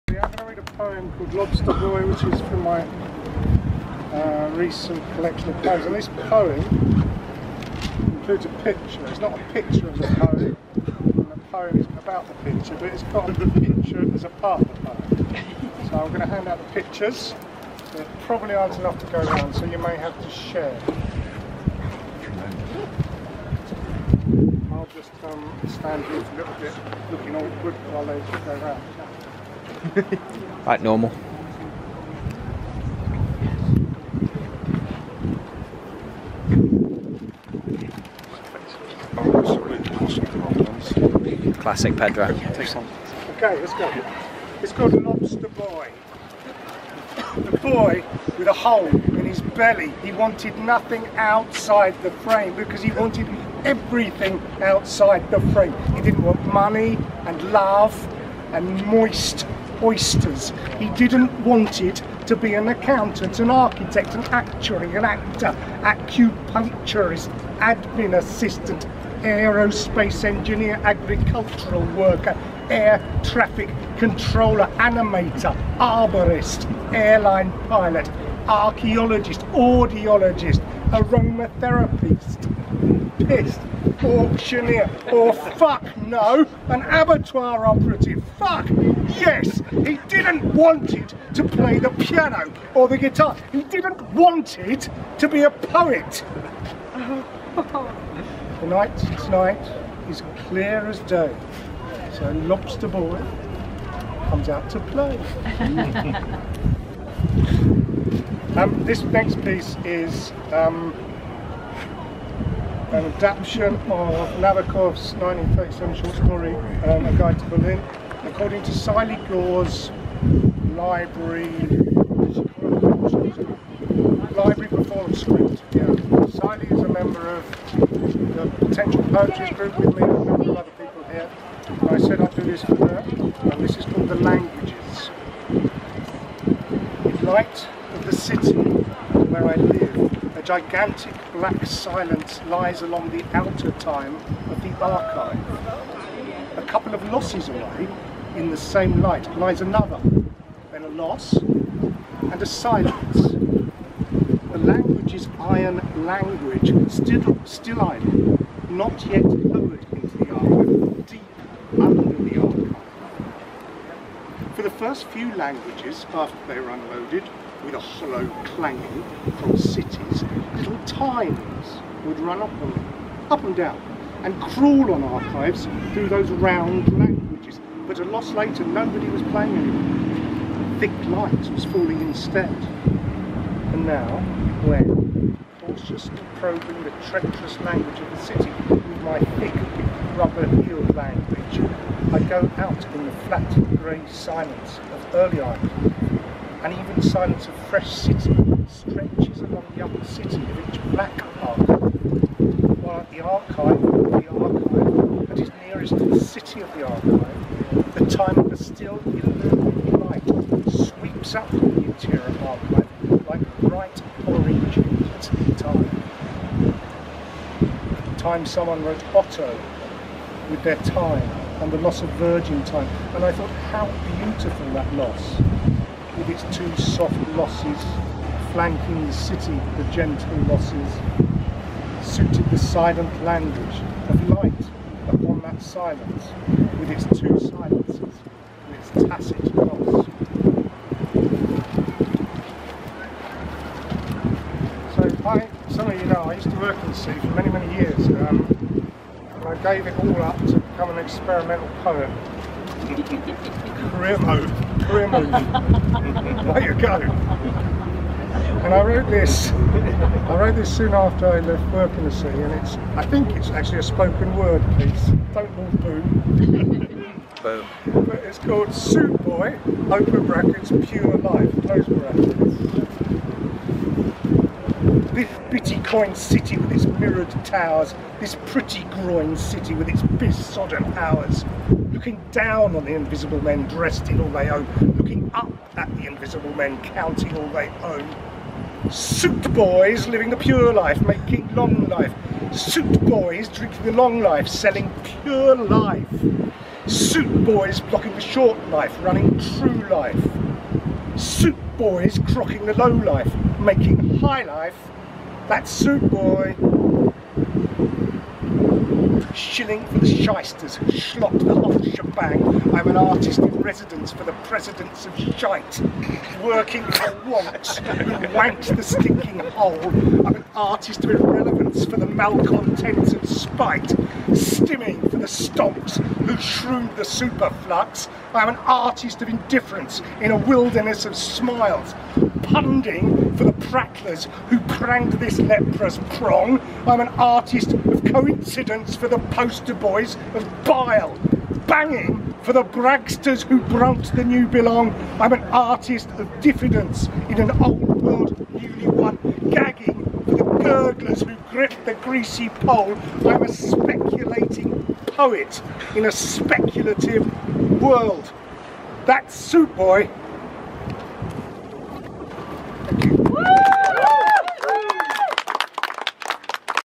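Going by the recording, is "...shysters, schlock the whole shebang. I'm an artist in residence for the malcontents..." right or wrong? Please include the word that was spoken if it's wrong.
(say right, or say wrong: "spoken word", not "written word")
wrong: "presidents", not "malcontents".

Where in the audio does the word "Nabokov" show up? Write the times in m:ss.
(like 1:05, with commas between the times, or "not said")
1:54.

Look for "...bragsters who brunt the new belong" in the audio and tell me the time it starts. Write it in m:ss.
5:42.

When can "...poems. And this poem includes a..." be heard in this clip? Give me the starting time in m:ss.
0:05.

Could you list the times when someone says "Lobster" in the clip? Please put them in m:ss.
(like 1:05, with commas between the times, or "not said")
0:01, 0:45, 1:42.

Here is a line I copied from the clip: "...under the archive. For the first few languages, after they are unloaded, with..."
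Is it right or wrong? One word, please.
right.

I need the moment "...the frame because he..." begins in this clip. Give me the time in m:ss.
0:52.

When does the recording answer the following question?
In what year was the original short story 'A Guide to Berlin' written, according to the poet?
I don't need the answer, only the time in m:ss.
1:55.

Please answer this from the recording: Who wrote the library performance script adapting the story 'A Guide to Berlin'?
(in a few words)
Sylee Gore.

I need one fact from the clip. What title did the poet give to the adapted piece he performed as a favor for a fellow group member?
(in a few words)
The Languages.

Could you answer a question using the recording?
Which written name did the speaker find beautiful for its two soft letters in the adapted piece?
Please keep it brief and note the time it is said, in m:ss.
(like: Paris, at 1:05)
Otto, at 3:39.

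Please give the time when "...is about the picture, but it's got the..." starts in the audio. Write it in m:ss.
0:11.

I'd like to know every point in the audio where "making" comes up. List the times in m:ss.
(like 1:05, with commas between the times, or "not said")
4:51, 5:03.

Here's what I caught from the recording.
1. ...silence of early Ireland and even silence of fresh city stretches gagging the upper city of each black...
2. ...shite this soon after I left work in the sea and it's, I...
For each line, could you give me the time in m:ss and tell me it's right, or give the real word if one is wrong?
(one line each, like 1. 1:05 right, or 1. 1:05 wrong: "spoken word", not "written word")
1. 3:14 wrong: "along", not "gagging"
2. 4:20 wrong: "wrote", not "shite".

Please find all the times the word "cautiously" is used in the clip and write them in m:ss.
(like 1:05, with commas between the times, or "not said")
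3:05.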